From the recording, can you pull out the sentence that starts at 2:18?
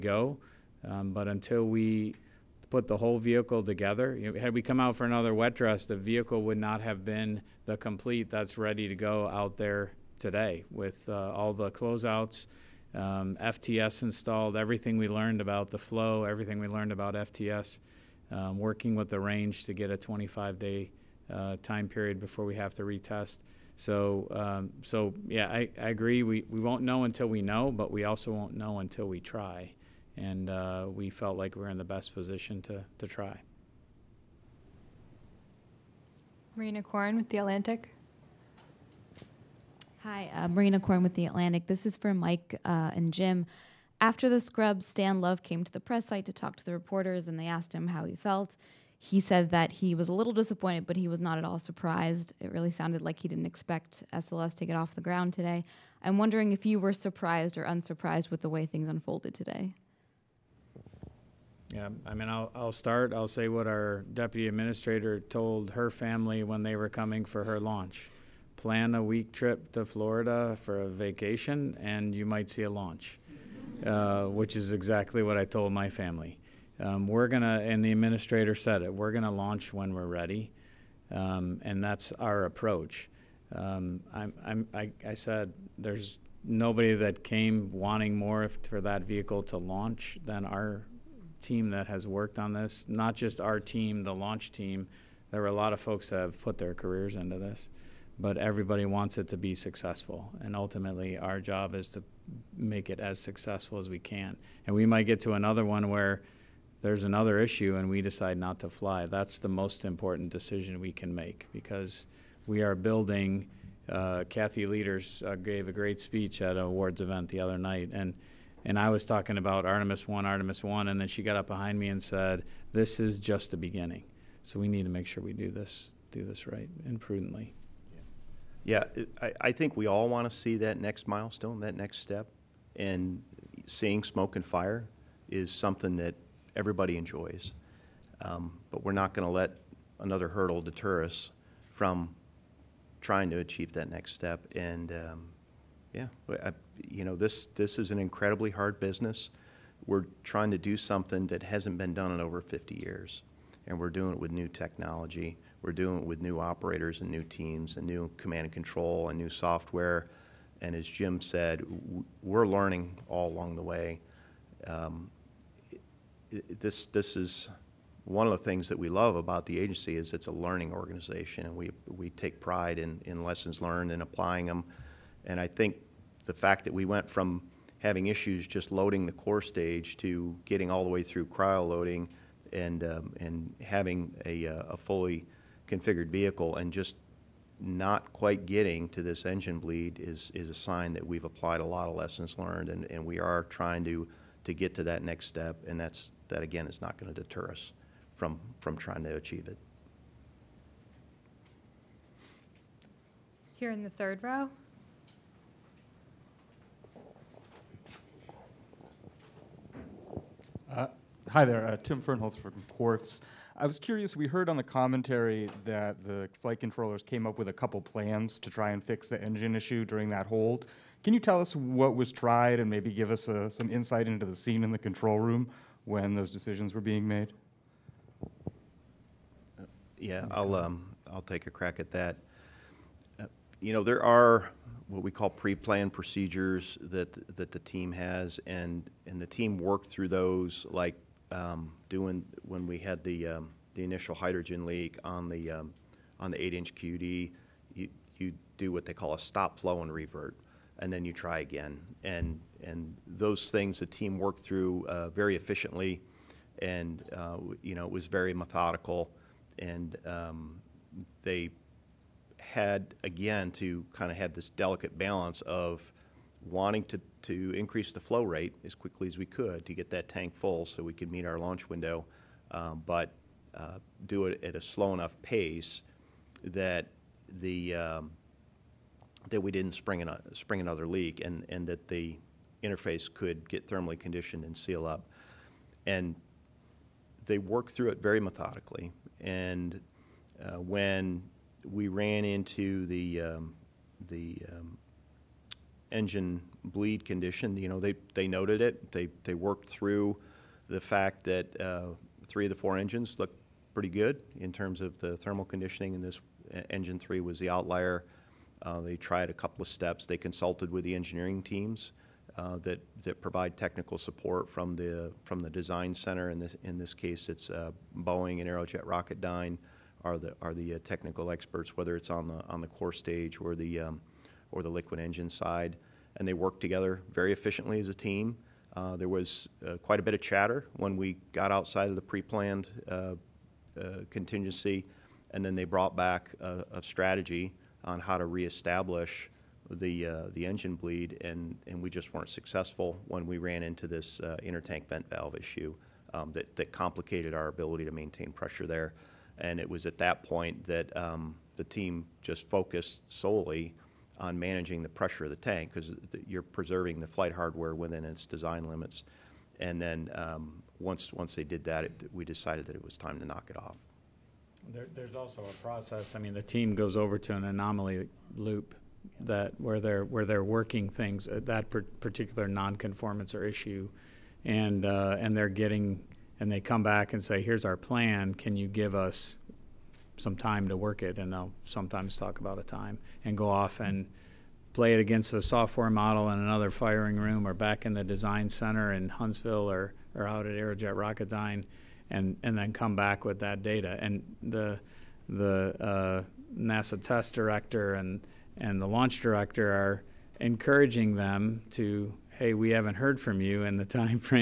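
Um, but we're not going to let another hurdle deter us from trying to achieve that next step.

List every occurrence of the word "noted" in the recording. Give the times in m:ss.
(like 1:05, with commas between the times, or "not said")
4:58.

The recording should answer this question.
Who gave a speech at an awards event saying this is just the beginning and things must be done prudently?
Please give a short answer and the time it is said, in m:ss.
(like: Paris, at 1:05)
Kathy Lueders, at 1:54.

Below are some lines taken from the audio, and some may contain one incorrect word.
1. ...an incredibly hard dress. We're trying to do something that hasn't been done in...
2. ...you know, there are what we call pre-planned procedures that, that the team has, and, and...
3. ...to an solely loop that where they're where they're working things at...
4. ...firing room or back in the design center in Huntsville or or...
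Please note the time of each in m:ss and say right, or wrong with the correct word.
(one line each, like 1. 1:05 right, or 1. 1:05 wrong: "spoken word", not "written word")
1. 2:27 wrong: "business", not "dress"
2. 3:53 right
3. 6:07 wrong: "anomaly", not "solely"
4. 6:26 right.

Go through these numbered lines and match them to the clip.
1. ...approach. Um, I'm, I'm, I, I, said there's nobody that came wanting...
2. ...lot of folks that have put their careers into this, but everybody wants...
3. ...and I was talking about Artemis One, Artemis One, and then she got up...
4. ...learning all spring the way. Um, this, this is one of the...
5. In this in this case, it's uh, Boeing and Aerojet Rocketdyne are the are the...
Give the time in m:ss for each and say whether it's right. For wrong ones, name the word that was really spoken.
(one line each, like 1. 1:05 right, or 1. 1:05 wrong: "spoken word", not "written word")
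1. 1:22 right
2. 1:35 right
3. 1:58 right
4. 2:42 wrong: "along", not "spring"
5. 5:16 right.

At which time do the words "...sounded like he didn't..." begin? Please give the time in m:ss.
0:52.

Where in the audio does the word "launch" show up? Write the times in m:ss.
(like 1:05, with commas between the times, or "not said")
1:07, 1:12, 1:19, 1:29, 1:34, 4:31, 6:38.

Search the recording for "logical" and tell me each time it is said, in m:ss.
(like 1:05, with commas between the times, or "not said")
not said.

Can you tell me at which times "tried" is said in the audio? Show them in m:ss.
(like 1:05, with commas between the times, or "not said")
3:42, 5:08.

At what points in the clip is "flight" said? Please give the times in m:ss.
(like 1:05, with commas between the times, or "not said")
3:36, 5:57.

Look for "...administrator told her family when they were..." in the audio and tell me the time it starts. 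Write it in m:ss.
1:04.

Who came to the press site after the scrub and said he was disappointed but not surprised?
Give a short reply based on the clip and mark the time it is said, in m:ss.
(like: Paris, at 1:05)
Stan Love, at 0:44.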